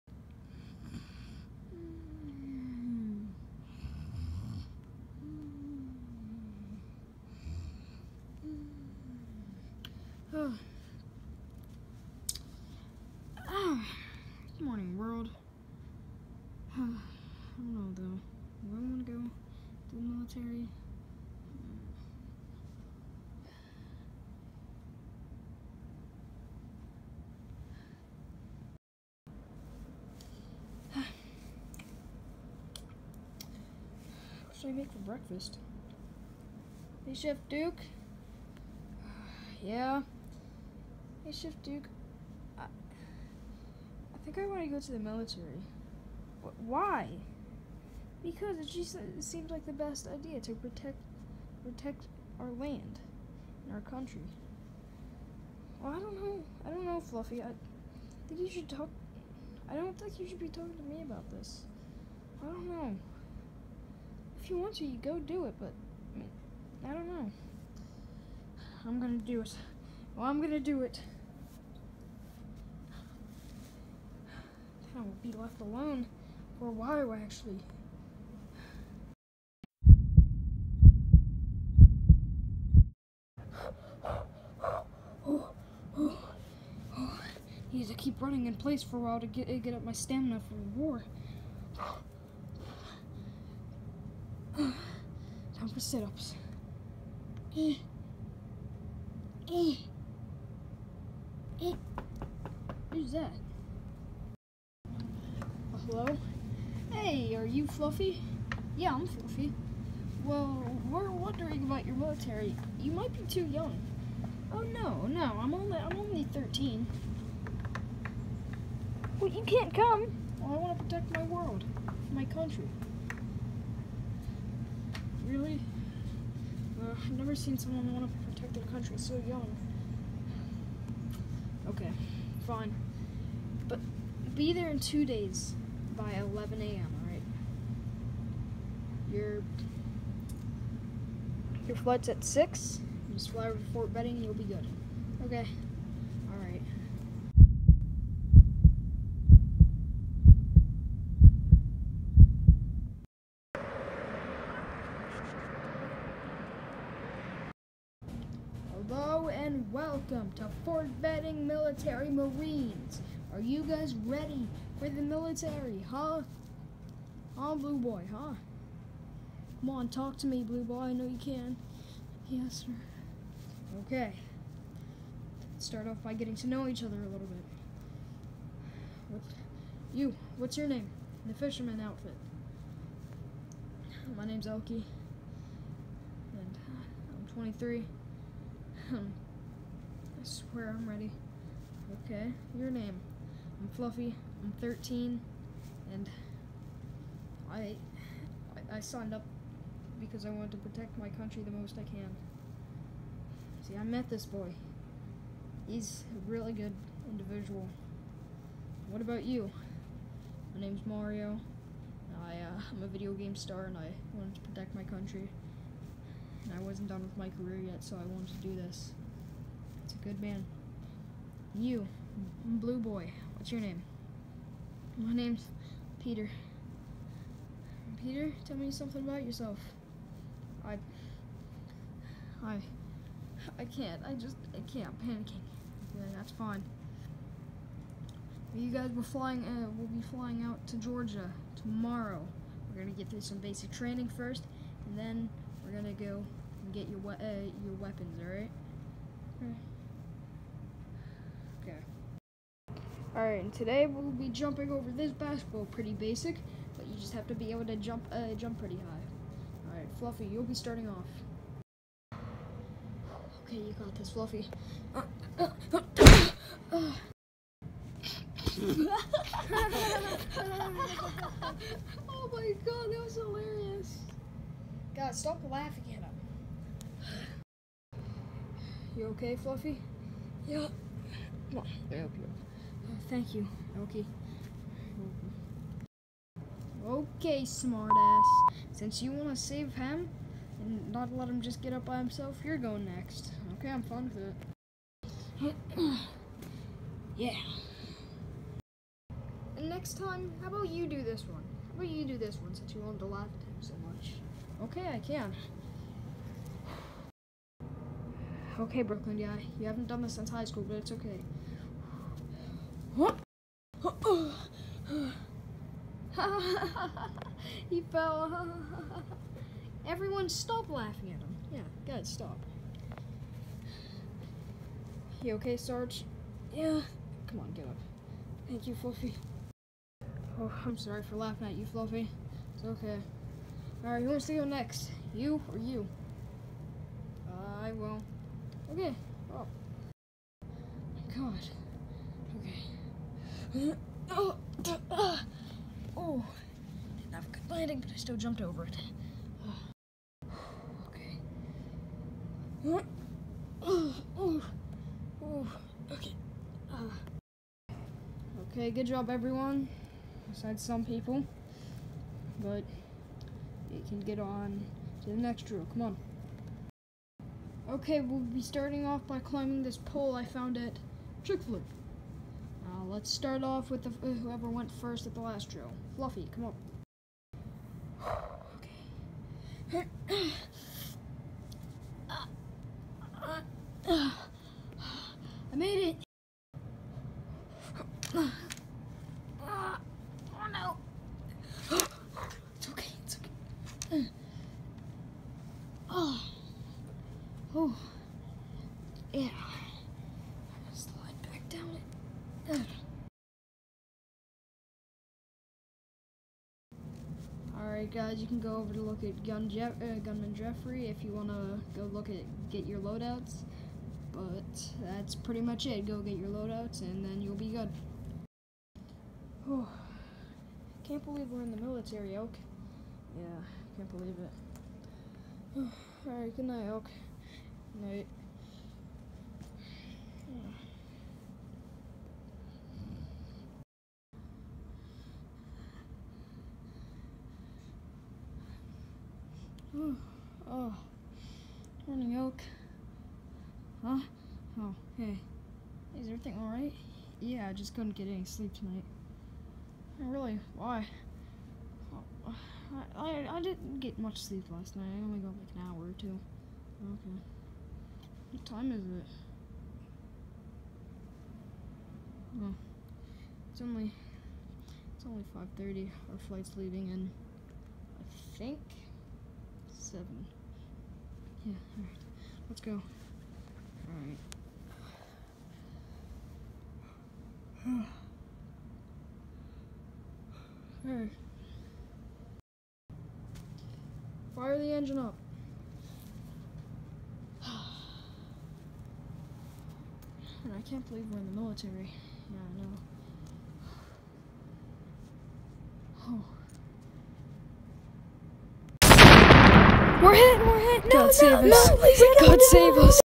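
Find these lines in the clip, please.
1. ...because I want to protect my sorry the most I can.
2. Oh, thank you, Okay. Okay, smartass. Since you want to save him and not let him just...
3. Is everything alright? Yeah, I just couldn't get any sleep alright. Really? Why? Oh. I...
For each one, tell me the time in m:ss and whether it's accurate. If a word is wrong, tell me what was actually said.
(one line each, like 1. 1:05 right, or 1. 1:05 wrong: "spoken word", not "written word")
1. 3:20 wrong: "country", not "sorry"
2. 4:42 right
3. 7:25 wrong: "tonight", not "alright".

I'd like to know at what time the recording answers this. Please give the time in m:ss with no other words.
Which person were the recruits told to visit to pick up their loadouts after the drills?
6:50.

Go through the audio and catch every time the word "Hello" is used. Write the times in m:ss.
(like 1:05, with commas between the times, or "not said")
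1:45, 2:38.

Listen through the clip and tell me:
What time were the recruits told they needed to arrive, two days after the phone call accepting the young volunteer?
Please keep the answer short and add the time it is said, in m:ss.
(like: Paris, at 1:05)
11 a.m., at 2:16.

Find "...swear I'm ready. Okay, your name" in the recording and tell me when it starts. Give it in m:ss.
3:10.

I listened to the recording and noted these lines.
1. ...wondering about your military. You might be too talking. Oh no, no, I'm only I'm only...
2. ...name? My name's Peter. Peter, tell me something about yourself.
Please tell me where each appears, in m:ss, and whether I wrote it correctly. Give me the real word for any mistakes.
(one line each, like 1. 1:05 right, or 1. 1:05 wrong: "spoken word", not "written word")
1. 1:51 wrong: "young", not "talking"
2. 3:43 right.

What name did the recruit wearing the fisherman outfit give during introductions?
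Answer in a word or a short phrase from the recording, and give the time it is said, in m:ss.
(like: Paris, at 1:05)
Elkie, at 3:04.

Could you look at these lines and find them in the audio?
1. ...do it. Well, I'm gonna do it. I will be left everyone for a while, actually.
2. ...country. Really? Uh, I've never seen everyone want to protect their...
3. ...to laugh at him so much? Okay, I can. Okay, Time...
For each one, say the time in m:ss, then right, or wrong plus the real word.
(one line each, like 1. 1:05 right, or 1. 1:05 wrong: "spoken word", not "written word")
1. 1:09 wrong: "alone", not "everyone"
2. 2:02 wrong: "someone", not "everyone"
3. 5:02 wrong: "Brooklyn", not "Time".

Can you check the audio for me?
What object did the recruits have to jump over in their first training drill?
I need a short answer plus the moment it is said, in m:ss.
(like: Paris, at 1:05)
basketball, at 4:15.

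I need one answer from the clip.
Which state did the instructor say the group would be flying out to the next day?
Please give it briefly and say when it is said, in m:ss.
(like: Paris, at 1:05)
Georgia, at 4:00.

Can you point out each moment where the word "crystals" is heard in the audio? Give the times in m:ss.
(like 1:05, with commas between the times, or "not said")
not said.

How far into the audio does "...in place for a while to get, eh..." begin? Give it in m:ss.
1:28.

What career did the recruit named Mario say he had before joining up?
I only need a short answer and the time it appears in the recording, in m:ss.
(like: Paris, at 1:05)
video game star, at 3:32.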